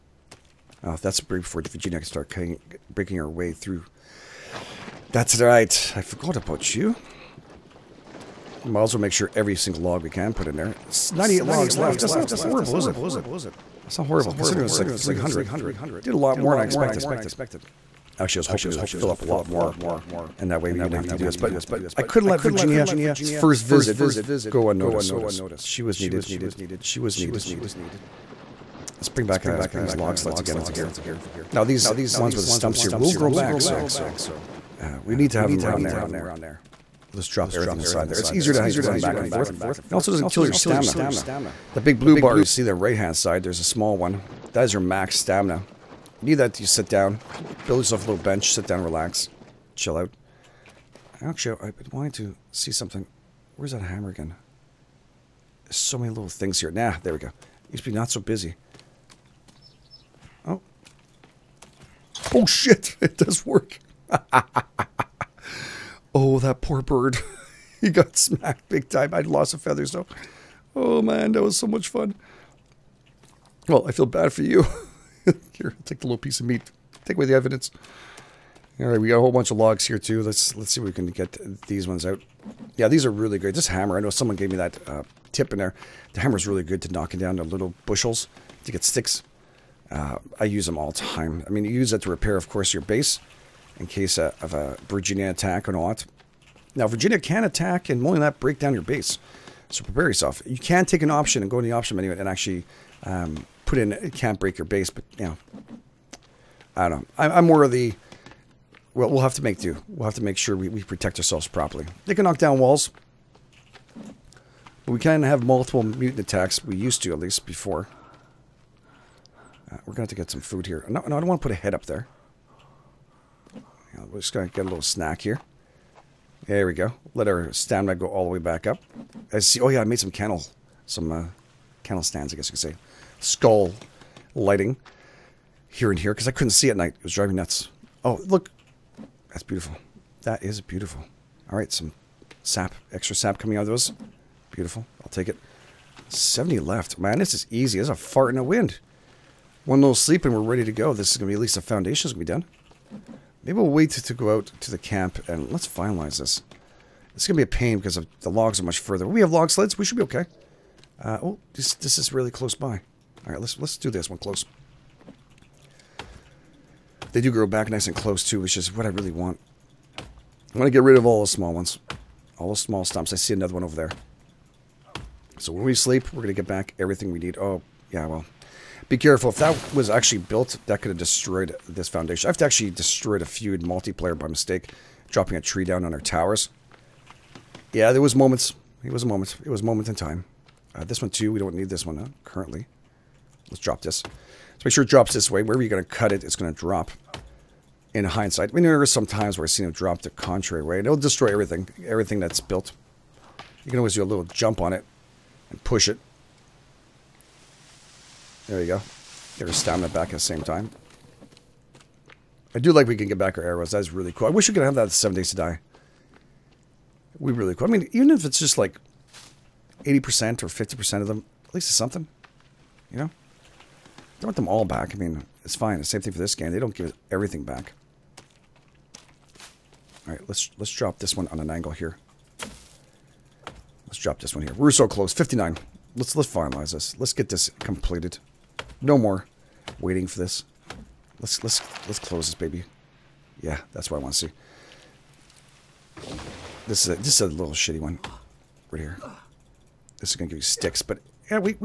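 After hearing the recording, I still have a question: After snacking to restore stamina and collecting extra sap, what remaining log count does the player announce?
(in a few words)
70.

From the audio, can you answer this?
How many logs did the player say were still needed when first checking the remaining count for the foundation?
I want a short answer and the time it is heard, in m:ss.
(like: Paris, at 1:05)
98, at 0:11.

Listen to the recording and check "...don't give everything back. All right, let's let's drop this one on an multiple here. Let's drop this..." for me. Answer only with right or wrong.
wrong.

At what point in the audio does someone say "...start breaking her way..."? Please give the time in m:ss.
0:02.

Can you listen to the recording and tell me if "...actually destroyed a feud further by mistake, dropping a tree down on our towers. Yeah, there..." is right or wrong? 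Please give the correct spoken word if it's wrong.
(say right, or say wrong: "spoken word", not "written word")
wrong: "multiplayer", not "further".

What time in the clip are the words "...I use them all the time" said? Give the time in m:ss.
1:30.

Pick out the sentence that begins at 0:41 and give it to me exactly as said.
The big blue bar you see the right-hand side, there's a small one.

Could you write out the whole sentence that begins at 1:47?
I'm, I'm more of the well, we'll have to make do.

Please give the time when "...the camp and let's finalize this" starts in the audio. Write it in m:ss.
2:34.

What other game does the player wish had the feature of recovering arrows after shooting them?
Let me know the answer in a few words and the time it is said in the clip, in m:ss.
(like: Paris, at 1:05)
Seven Days to Die, at 3:34.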